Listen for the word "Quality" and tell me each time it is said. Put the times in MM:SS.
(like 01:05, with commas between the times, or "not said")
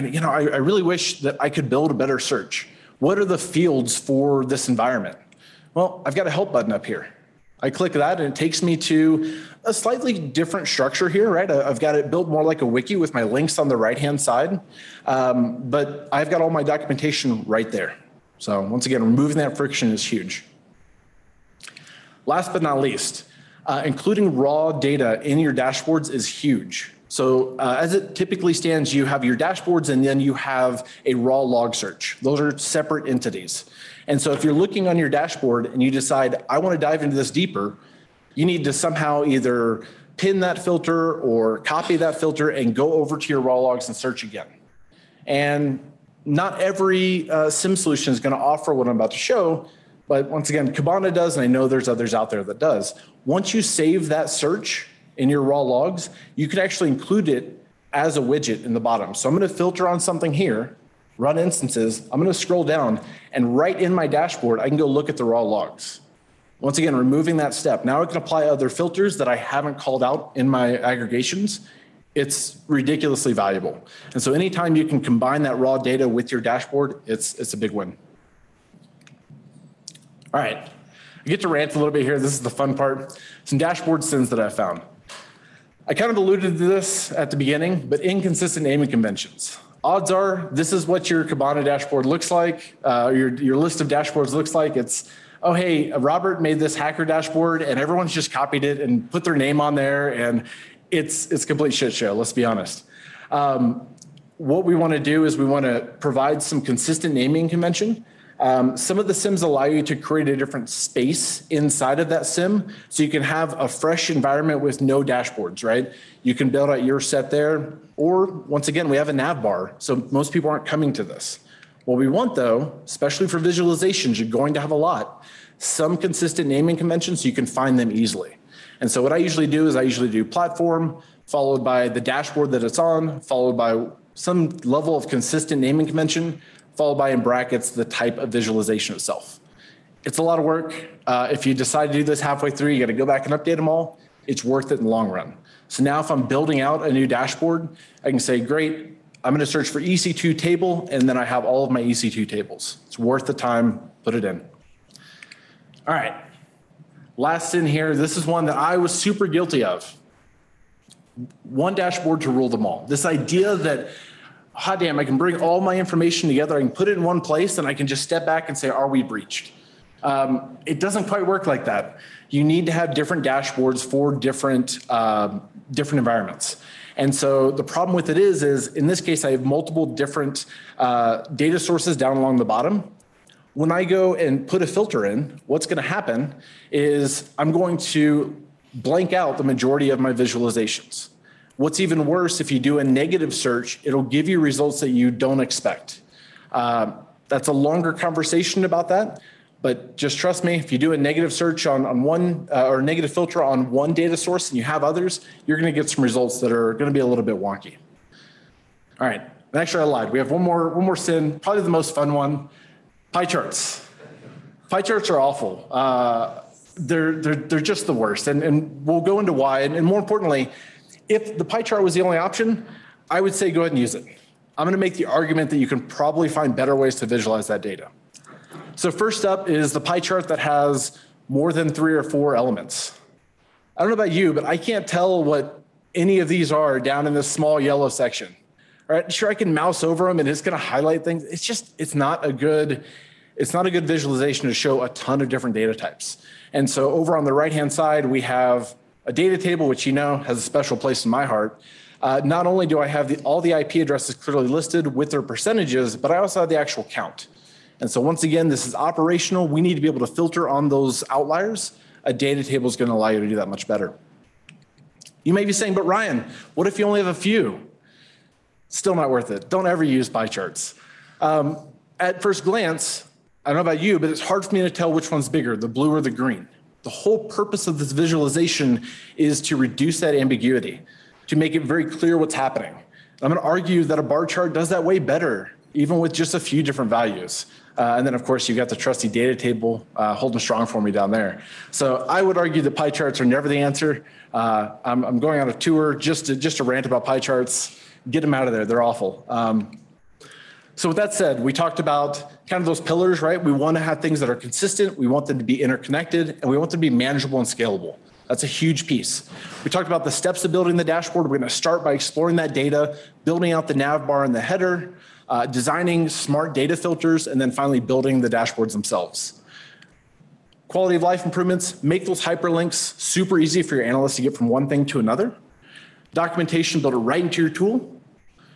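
05:20.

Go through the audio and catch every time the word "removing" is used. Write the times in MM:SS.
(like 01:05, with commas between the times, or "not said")
00:19, 01:06.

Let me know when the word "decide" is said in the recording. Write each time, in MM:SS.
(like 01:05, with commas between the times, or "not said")
00:35, 02:21.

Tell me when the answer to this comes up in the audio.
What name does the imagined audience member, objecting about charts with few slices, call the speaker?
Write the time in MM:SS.
04:25.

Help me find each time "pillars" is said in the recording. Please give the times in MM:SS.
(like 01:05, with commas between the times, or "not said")
05:02.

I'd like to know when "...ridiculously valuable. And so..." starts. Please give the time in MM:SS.
01:12.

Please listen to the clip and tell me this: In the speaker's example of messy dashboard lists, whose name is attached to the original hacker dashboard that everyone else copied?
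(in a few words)
Robert.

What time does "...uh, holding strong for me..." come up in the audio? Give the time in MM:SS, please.
04:49.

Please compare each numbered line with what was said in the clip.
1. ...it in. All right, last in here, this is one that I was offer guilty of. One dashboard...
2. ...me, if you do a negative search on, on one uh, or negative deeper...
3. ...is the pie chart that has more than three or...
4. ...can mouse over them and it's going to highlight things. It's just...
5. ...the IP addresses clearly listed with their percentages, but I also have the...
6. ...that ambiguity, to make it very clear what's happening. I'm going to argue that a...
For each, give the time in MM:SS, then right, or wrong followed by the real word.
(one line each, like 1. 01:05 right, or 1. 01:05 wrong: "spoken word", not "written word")
1. 02:34 wrong: "super", not "offer"
2. 03:20 wrong: "filter", not "deeper"
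3. 03:49 right
4. 03:59 right
5. 04:13 right
6. 04:39 right.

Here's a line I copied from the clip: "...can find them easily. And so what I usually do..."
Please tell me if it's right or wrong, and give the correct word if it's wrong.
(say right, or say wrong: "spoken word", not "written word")
right.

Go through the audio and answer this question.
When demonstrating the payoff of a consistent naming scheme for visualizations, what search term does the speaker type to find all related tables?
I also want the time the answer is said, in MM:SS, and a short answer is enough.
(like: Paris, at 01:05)
EC2 table, at 02:29.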